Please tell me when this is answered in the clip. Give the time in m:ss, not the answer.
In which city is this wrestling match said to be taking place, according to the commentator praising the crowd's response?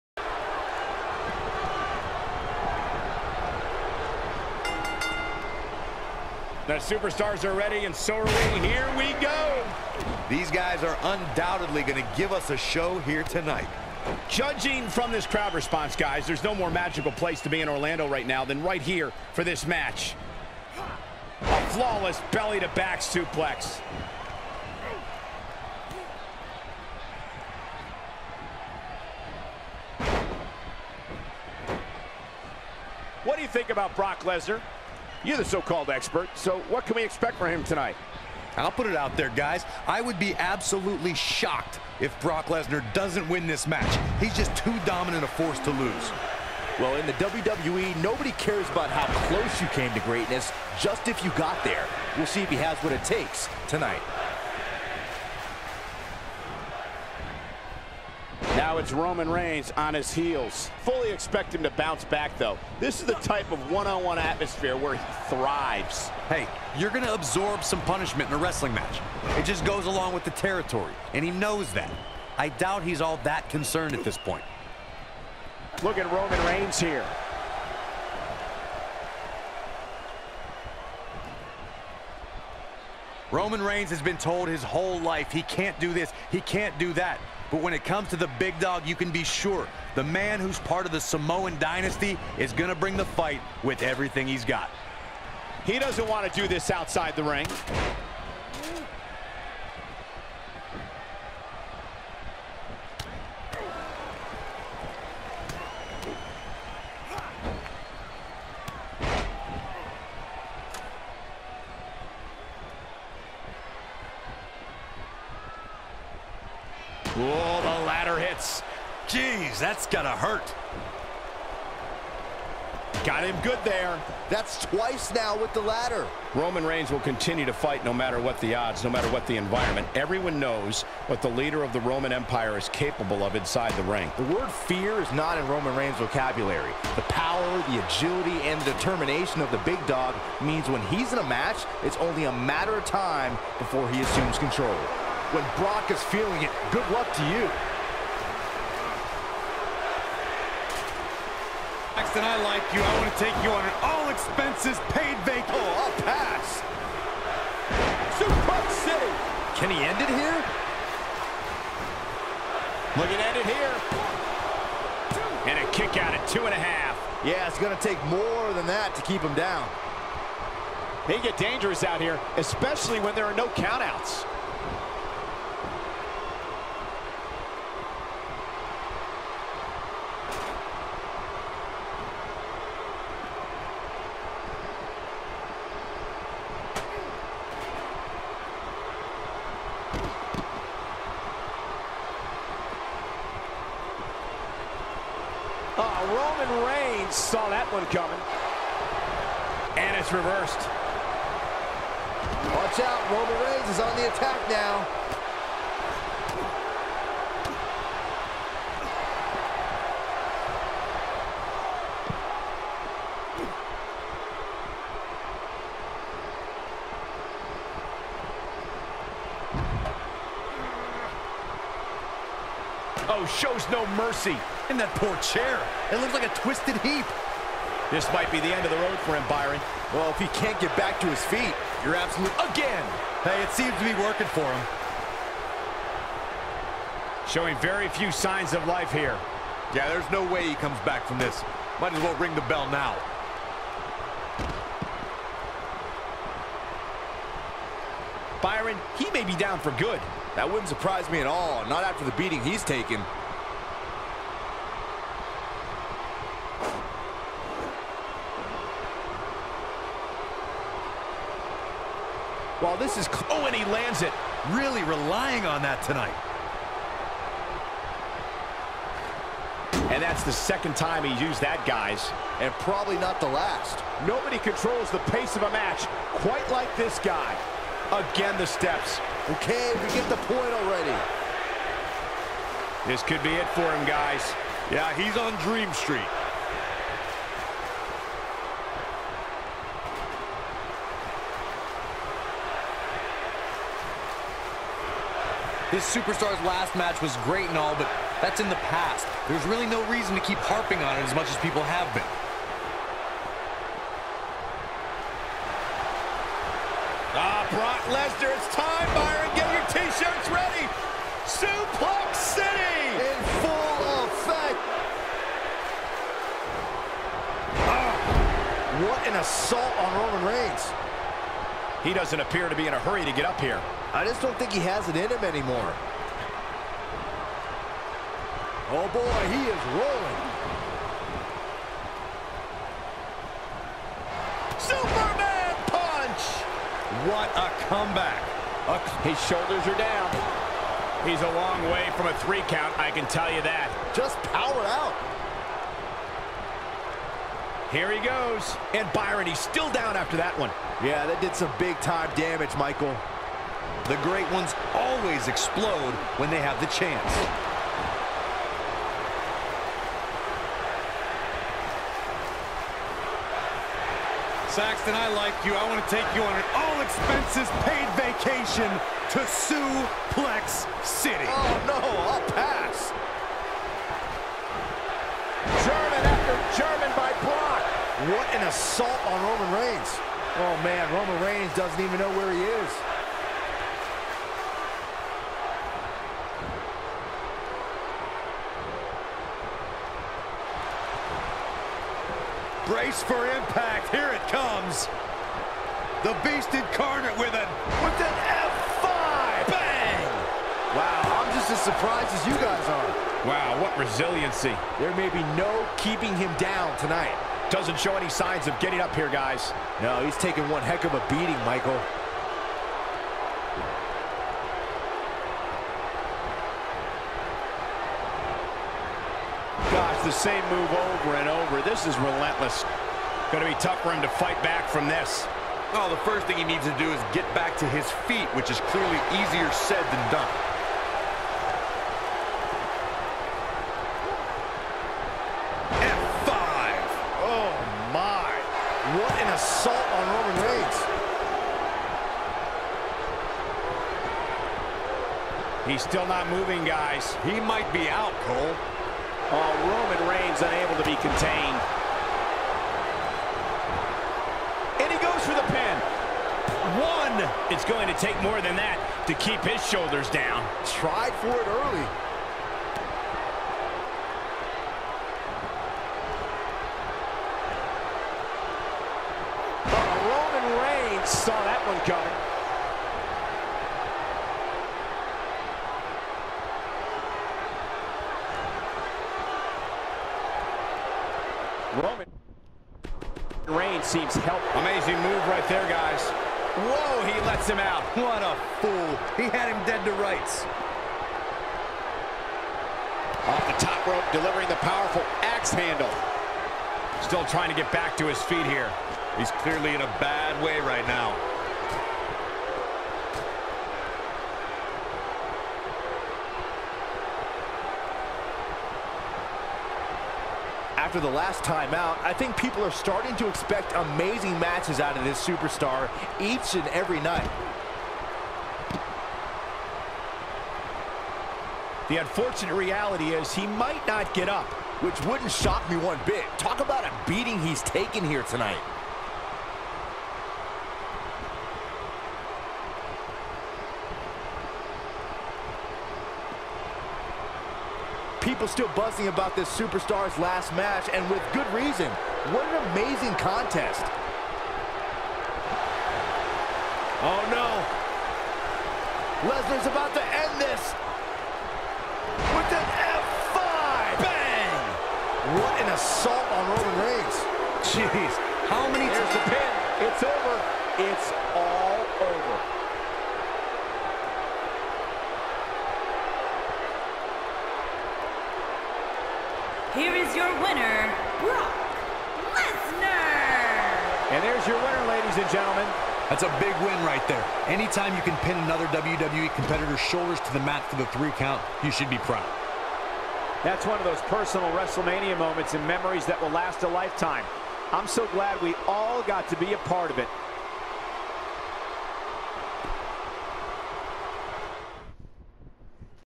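0:17.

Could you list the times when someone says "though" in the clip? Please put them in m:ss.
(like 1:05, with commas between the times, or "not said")
1:02.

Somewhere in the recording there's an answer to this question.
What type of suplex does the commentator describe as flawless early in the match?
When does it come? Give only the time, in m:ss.
0:22.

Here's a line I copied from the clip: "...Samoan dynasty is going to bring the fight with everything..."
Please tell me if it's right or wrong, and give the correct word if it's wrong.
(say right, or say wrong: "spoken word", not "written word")
right.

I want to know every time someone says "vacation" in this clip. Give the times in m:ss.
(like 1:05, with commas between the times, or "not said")
2:35, 6:07.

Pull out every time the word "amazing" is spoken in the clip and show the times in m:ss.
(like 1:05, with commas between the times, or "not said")
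8:04, 8:33, 9:02.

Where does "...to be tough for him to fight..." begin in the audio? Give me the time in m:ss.
7:03.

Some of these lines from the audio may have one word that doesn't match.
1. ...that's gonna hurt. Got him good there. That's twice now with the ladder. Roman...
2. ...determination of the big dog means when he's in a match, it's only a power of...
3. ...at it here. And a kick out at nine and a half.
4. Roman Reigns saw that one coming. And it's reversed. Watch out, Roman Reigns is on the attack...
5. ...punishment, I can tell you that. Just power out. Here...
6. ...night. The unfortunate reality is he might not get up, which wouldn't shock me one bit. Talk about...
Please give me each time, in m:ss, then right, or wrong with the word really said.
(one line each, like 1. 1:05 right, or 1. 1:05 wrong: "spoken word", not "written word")
1. 1:59 right
2. 2:18 wrong: "matter", not "power"
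3. 2:43 wrong: "two", not "nine"
4. 3:16 right
5. 5:42 wrong: "count", not "punishment"
6. 8:36 right.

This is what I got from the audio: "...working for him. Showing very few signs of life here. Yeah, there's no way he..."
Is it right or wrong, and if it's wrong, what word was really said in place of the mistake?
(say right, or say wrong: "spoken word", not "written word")
right.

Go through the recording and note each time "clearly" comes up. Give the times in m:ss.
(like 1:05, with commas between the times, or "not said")
7:08, 8:19.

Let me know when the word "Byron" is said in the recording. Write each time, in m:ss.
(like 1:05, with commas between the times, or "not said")
3:49, 4:08, 5:48.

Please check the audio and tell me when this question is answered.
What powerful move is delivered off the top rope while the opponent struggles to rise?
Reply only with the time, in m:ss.
8:15.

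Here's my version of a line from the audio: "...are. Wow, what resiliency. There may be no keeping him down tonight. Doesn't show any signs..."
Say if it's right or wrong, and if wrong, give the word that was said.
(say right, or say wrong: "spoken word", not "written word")
right.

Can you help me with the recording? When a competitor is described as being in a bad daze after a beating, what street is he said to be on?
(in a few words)
Dream Street.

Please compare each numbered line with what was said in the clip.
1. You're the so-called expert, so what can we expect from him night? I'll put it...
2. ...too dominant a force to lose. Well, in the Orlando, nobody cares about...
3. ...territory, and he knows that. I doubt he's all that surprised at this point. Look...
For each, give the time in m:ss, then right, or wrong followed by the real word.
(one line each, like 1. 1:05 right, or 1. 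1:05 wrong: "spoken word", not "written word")
1. 0:35 wrong: "tonight", not "night"
2. 0:44 wrong: "WWE", not "Orlando"
3. 1:10 wrong: "concerned", not "surprised".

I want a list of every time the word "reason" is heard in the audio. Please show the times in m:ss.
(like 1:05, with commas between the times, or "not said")
4:59, 9:01.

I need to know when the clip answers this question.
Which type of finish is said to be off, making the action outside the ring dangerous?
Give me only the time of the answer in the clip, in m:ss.
2:53.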